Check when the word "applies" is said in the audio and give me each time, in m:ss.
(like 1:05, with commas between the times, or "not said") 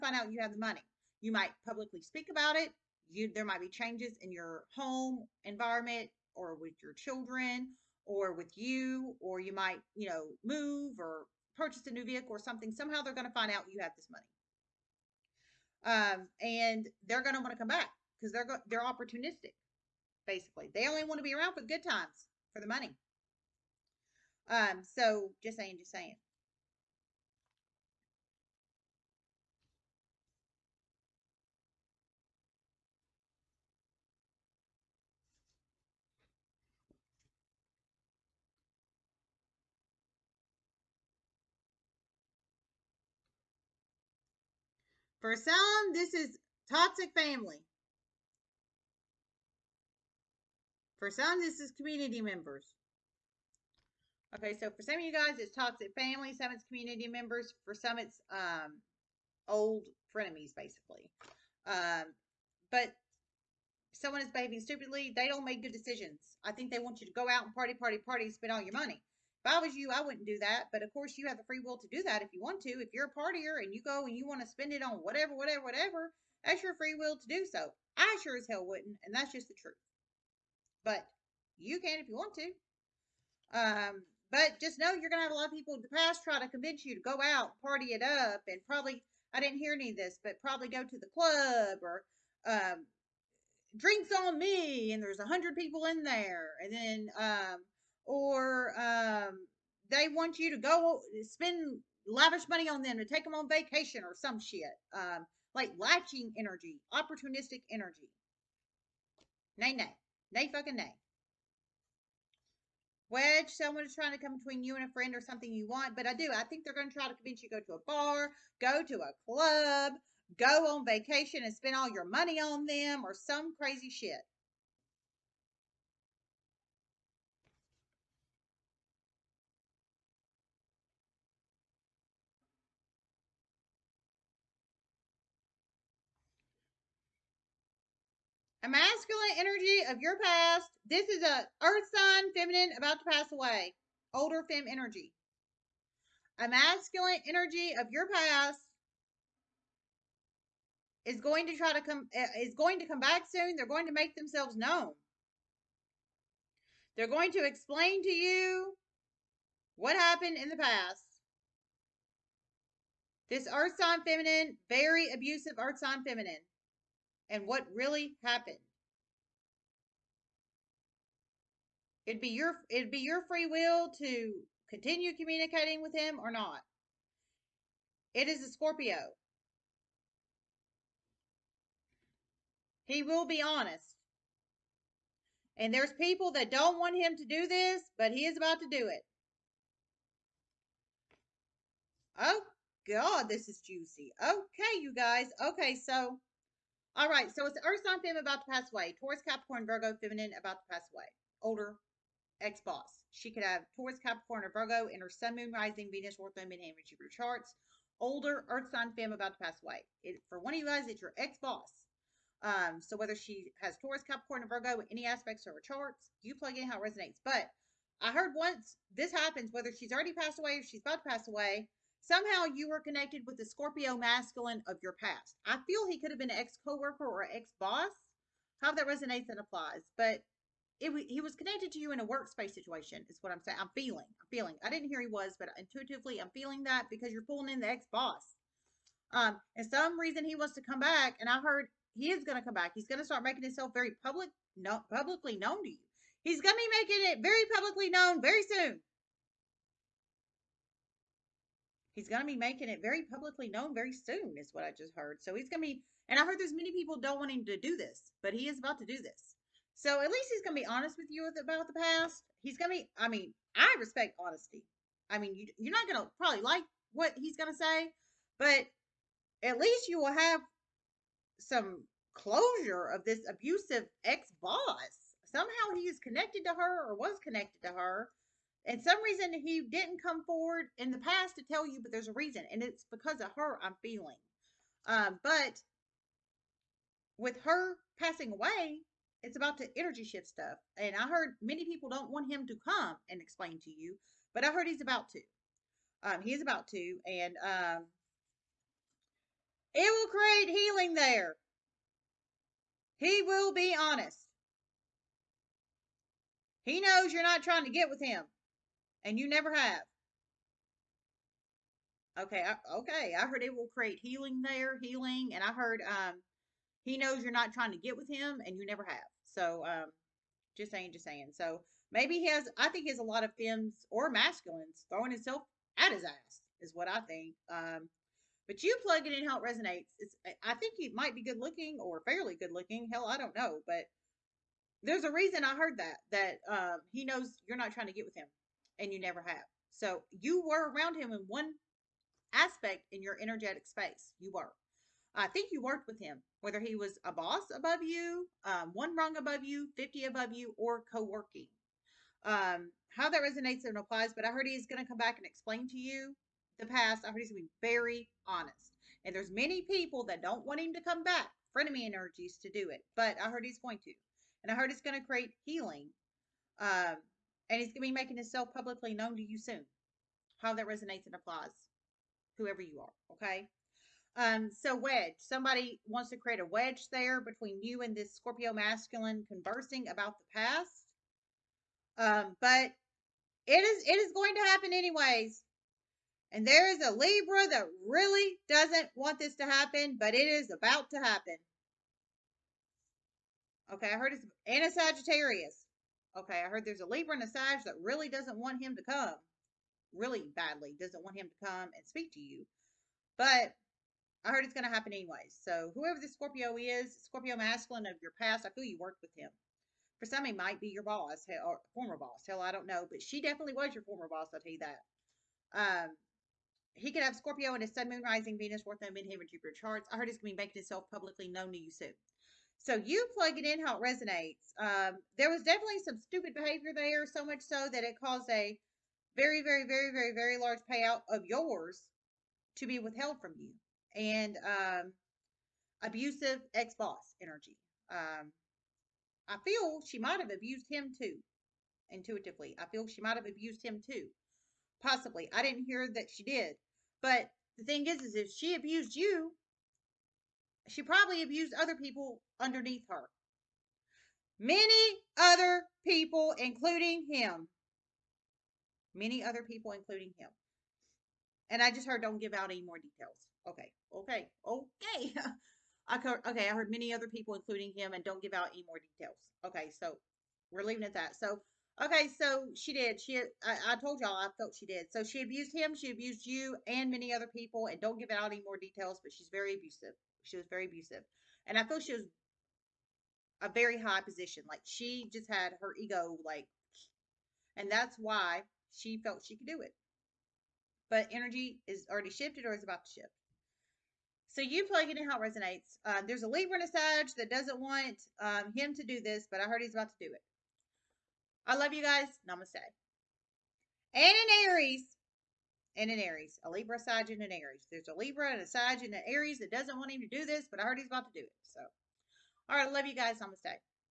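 3:49, 5:53, 6:11.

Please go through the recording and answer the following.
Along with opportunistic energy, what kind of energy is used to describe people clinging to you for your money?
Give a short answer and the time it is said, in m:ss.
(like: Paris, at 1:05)
latching energy, at 1:45.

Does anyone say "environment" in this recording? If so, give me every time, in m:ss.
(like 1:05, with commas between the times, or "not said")
0:05.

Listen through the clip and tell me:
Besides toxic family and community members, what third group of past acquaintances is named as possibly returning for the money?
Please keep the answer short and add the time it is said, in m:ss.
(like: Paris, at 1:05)
old frenemies, at 0:59.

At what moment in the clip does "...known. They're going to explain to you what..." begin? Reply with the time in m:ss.
2:34.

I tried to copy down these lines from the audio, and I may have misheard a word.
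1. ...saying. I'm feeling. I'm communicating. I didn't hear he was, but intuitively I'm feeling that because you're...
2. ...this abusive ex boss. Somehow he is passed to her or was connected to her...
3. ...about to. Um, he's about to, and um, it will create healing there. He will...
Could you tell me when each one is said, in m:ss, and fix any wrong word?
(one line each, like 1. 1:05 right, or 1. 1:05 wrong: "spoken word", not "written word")
1. 3:53 wrong: "feeling", not "communicating"
2. 4:33 wrong: "connected", not "passed"
3. 4:54 right.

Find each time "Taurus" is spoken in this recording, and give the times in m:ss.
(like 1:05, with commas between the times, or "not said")
3:19, 3:23, 3:33.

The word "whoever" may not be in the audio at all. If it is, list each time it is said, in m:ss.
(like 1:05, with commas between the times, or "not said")
6:12, 6:45.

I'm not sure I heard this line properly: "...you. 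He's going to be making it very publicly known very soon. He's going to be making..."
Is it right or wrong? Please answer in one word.
right.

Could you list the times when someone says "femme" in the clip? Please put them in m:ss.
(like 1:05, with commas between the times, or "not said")
3:18, 3:28, 5:23.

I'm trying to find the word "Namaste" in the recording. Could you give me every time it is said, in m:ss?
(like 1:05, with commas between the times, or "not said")
8:22, 8:33.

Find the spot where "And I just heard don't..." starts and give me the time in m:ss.
7:41.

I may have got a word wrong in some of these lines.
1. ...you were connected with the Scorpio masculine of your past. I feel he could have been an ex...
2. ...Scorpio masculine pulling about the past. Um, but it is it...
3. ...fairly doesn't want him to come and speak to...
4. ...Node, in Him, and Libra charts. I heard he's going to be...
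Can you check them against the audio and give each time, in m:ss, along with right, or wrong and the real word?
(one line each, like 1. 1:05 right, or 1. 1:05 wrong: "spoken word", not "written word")
1. 3:42 right
2. 6:18 wrong: "conversing", not "pulling"
3. 6:40 wrong: "badly", not "fairly"
4. 6:58 wrong: "Jupiter", not "Libra".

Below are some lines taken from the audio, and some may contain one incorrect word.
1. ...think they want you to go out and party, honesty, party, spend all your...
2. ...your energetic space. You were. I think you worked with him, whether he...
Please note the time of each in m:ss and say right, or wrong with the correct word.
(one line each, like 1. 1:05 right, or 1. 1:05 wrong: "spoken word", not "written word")
1. 1:06 wrong: "party", not "honesty"
2. 5:43 right.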